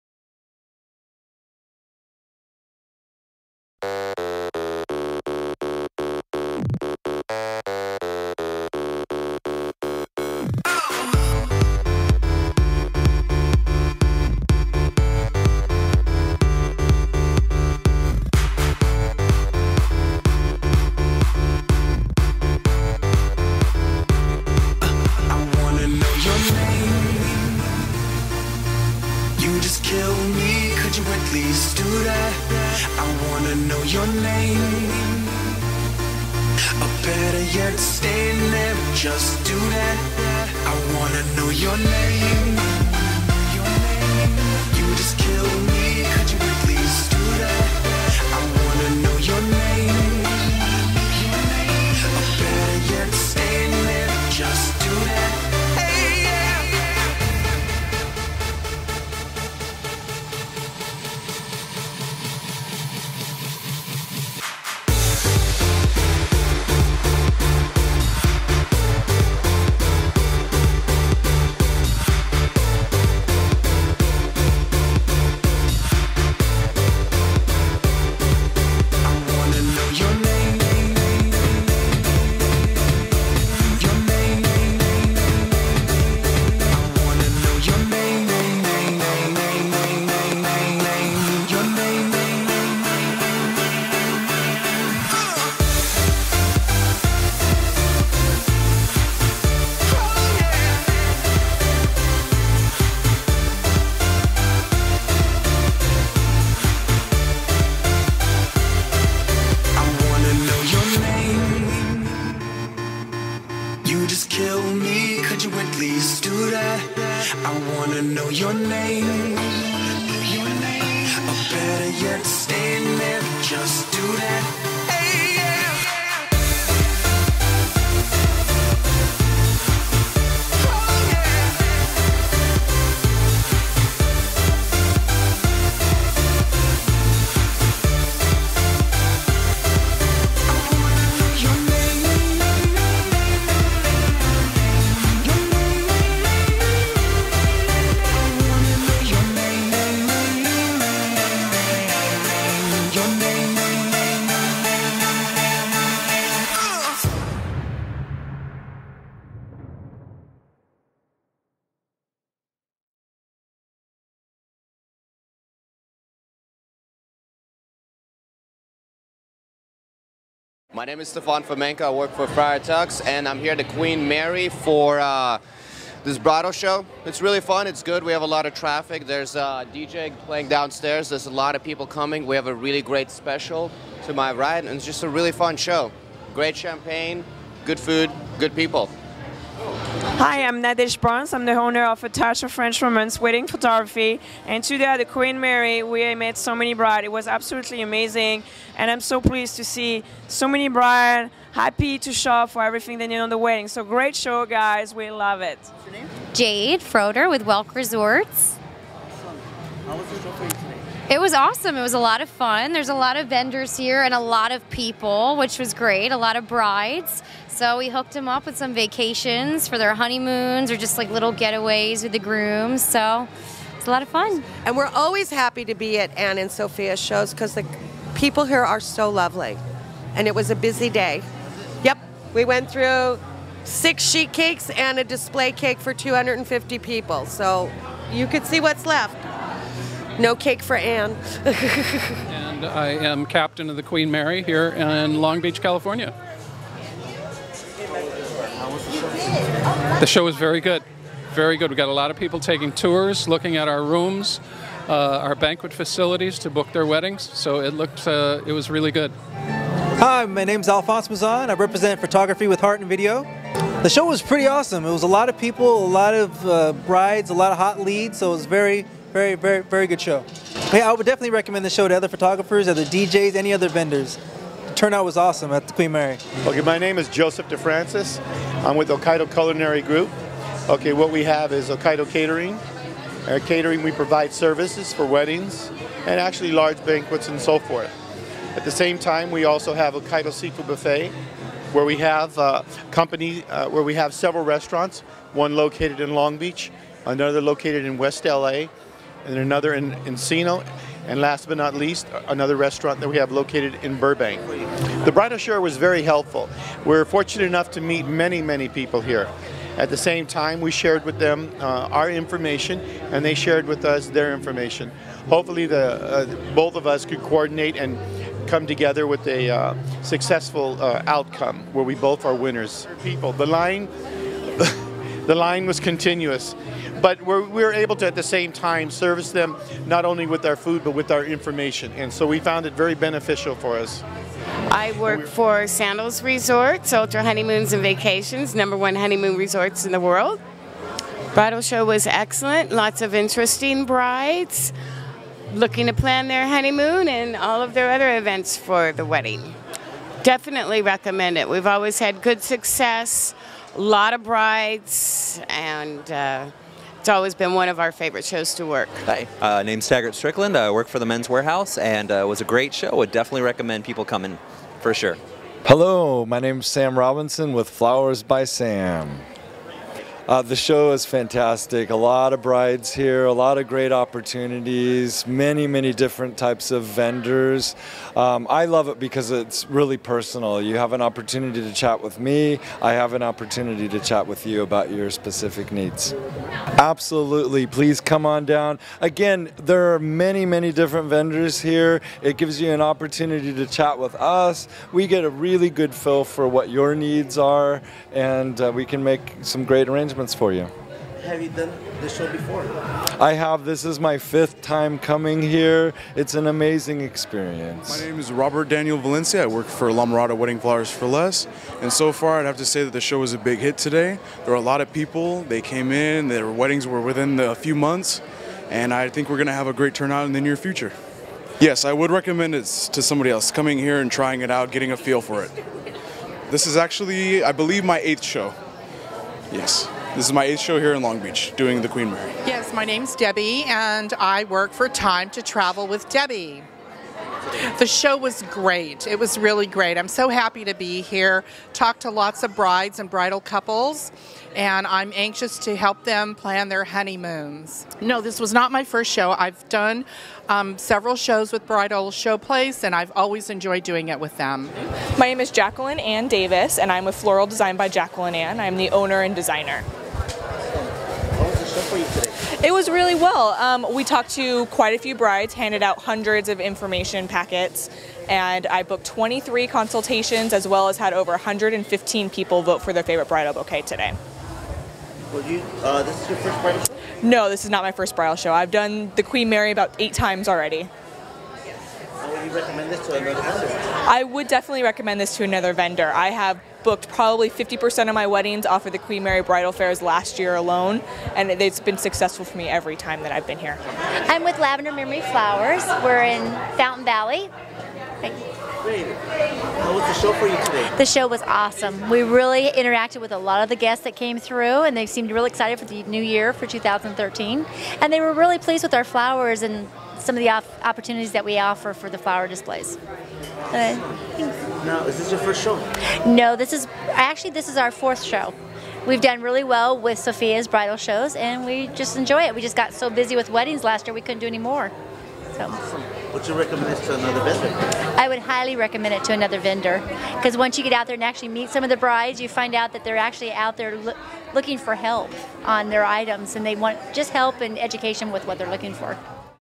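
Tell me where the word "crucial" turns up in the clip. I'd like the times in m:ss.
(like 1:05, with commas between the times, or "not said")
not said.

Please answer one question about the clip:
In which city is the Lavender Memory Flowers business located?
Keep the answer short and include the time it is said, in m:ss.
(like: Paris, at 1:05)
Fountain Valley, at 8:16.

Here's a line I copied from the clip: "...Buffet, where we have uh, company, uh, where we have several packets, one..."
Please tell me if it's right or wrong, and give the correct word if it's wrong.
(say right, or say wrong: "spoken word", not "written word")
wrong: "restaurants", not "packets".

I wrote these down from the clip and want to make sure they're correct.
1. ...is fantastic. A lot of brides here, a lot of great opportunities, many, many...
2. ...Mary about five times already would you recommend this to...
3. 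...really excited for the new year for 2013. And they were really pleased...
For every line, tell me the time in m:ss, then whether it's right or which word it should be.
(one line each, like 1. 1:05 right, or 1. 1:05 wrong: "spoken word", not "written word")
1. 6:10 right
2. 7:59 wrong: "eight", not "five"
3. 8:25 right.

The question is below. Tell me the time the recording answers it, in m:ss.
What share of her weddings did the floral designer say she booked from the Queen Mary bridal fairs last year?
8:07.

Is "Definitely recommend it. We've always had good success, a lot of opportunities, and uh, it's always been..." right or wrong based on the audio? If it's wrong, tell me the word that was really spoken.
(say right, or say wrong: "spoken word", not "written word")
wrong: "brides", not "opportunities".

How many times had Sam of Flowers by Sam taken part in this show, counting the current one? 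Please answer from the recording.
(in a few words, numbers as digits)
5.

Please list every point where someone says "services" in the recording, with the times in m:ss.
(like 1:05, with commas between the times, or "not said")
4:44, 5:28.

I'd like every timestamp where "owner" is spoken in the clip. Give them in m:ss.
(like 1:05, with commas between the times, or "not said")
3:11, 7:38.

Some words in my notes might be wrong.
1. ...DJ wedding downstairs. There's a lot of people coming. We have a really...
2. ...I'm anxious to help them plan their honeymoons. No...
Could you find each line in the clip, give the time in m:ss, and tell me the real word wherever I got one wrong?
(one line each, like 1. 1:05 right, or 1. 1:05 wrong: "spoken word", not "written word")
1. 2:59 wrong: "playing", not "wedding"
2. 7:24 right.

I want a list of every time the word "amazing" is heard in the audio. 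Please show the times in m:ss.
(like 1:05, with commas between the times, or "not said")
3:17, 6:46.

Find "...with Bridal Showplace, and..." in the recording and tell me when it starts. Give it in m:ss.
7:31.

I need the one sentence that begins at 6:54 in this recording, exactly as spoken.
There were a lot of people.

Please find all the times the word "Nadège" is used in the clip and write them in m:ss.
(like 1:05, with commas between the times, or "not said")
3:10.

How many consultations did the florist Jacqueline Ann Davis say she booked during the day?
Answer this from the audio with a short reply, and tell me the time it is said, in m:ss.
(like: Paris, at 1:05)
23, at 7:49.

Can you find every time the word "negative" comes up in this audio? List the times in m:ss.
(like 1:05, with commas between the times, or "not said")
not said.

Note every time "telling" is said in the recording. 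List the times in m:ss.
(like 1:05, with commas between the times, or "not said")
not said.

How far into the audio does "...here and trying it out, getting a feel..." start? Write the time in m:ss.
7:03.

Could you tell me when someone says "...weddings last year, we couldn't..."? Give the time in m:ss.
8:43.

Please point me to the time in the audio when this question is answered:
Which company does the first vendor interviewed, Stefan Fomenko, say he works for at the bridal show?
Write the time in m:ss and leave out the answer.
2:52.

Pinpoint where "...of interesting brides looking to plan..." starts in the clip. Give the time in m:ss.
5:43.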